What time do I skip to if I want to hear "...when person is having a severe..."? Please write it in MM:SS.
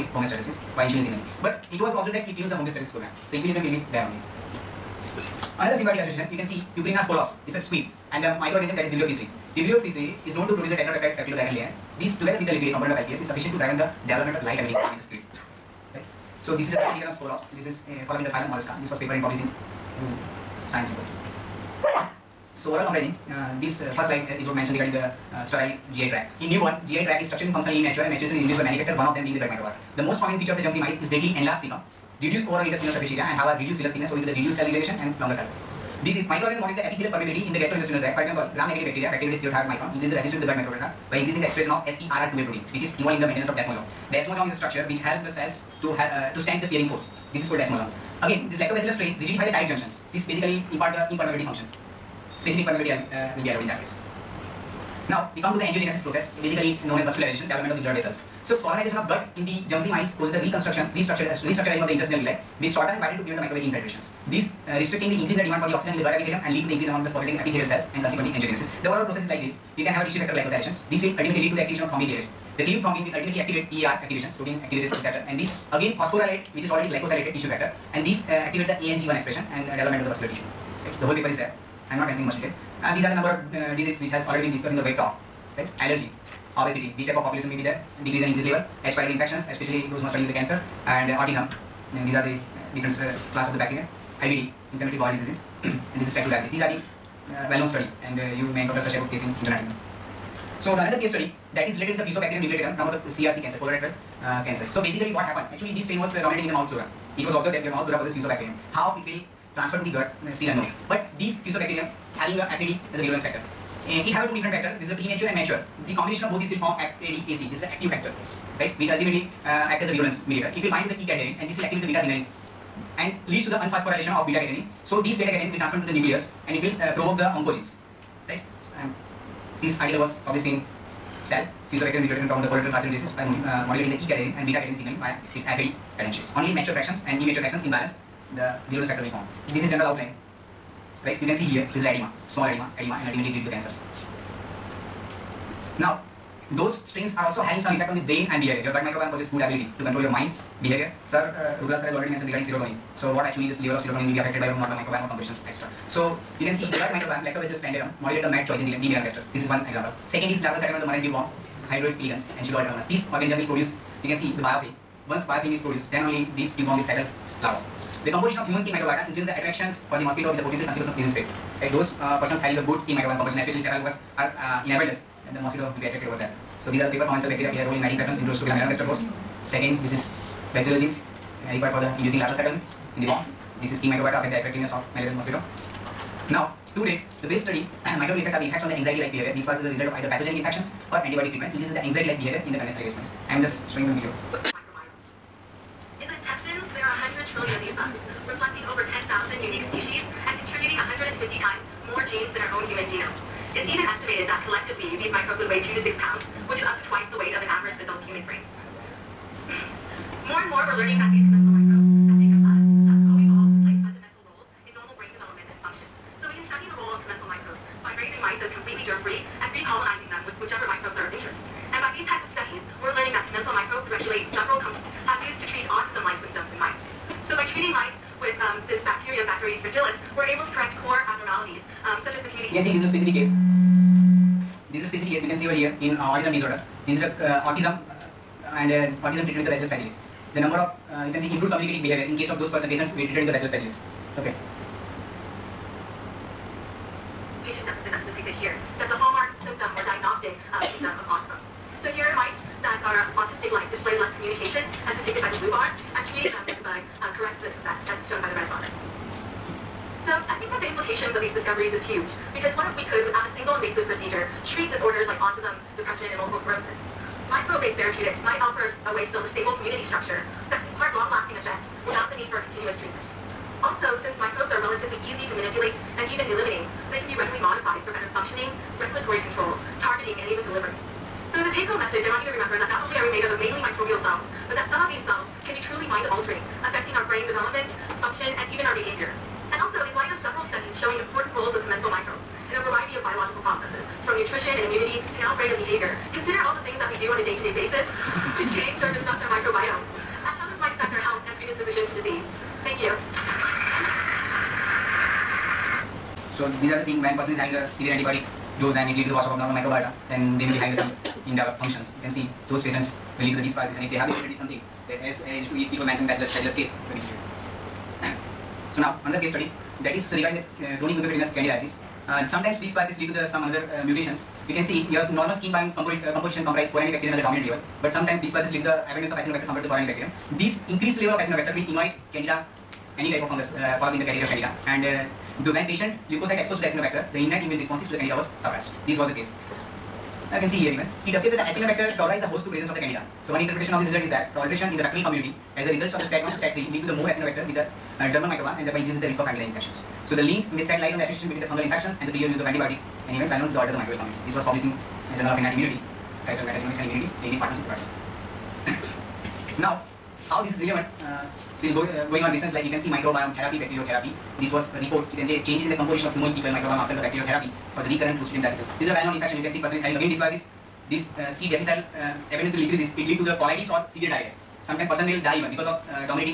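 05:07.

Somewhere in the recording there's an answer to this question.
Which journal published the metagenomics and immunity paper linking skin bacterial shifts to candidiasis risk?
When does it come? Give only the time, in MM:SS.
05:55.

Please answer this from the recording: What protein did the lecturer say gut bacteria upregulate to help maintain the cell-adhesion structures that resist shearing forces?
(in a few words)
SERR2A.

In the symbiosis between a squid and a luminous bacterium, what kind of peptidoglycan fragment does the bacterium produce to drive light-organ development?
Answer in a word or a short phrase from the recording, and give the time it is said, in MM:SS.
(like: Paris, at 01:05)
tetrapeptide, at 00:10.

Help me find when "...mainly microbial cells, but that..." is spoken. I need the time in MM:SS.
04:43.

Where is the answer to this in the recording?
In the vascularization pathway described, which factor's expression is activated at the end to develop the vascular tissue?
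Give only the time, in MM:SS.
01:18.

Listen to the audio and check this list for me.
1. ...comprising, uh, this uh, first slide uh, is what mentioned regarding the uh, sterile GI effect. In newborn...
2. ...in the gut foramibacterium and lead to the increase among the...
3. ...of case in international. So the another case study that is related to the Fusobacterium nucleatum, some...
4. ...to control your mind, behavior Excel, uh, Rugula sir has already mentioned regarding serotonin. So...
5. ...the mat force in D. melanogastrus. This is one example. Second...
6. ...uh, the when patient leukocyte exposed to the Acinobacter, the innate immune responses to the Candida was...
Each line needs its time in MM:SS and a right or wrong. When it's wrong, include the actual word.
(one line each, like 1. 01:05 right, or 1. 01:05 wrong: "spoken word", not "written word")
1. 00:22 wrong: "tract", not "effect"
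2. 01:05 wrong: "epithelium", not "foramibacterium"
3. 01:39 right
4. 02:29 wrong: "Sir", not "Excel"
5. 02:38 wrong: "choice", not "force"
6. 05:34 right.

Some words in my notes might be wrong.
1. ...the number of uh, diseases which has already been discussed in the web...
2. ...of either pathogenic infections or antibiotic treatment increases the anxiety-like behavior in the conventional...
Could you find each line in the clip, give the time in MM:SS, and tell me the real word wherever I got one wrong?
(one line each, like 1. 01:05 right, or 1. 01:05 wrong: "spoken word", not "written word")
1. 01:23 right
2. 03:09 right.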